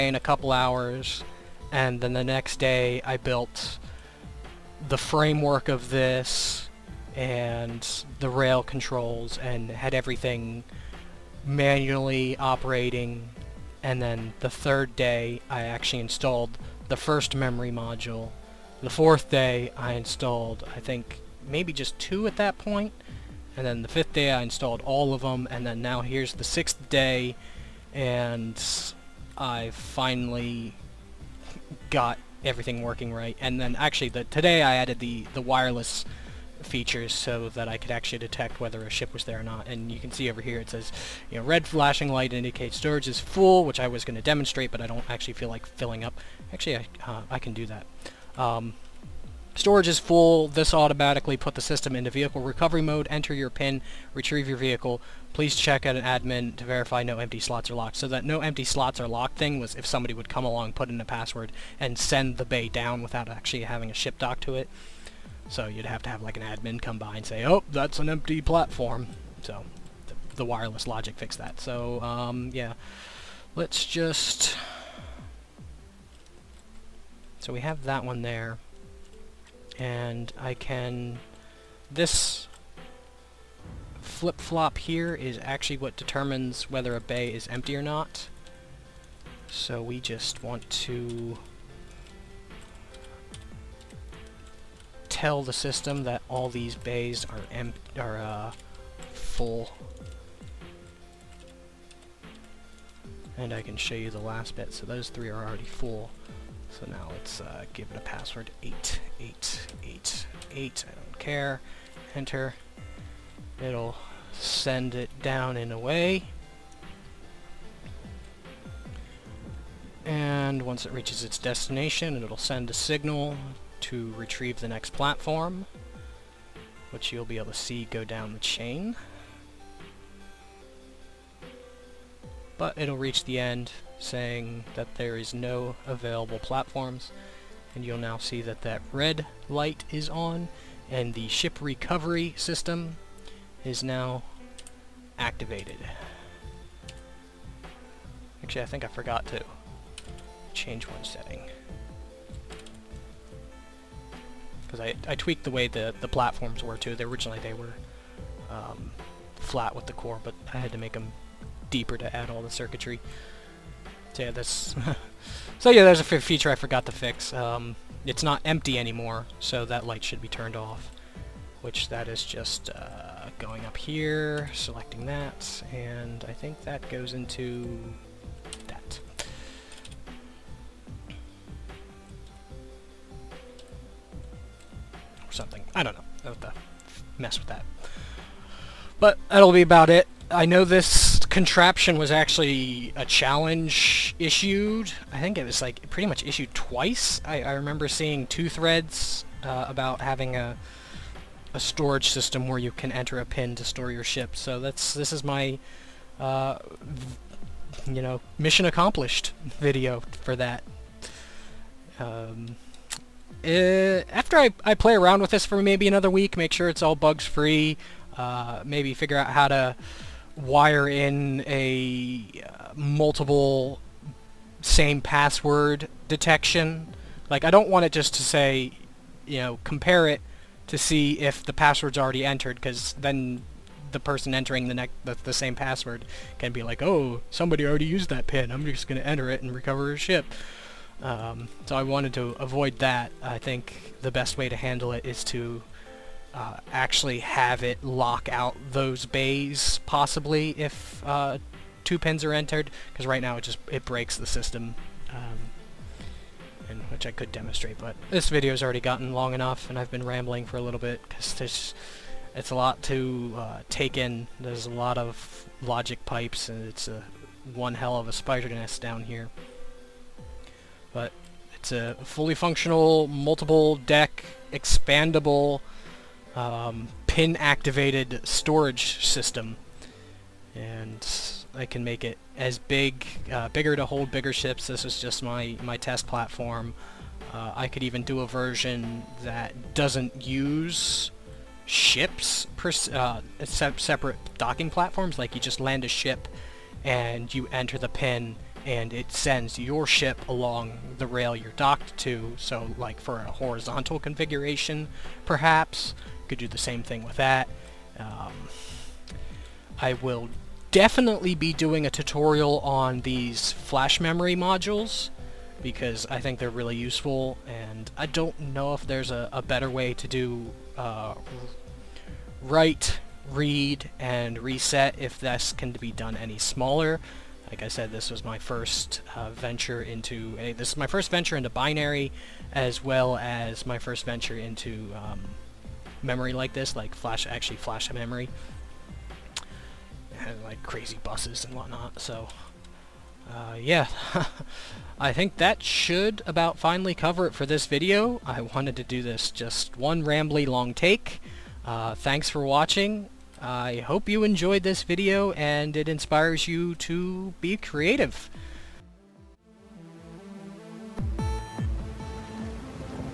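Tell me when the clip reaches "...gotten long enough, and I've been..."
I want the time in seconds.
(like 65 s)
258 s.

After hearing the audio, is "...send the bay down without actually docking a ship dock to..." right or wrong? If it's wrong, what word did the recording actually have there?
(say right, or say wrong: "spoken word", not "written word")
wrong: "having", not "docking".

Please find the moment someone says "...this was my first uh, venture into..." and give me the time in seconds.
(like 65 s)
327 s.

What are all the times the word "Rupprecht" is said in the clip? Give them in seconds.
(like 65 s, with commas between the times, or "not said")
not said.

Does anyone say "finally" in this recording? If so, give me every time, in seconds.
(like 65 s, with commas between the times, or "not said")
29 s, 346 s.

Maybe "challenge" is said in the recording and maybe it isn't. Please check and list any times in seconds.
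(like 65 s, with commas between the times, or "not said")
193 s.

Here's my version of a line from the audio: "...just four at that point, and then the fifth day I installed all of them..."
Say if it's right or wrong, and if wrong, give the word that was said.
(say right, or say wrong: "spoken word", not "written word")
wrong: "two", not "four".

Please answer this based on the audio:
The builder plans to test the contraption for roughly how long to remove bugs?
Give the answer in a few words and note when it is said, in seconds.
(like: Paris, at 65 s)
another week, at 215 s.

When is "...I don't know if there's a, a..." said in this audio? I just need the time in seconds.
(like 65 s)
317 s.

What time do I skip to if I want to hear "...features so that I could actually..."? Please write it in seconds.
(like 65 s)
36 s.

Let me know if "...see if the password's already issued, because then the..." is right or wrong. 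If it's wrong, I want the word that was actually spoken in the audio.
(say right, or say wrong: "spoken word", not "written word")
wrong: "entered", not "issued".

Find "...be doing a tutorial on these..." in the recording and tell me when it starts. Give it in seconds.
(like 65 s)
311 s.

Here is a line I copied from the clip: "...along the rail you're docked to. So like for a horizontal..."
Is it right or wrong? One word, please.
right.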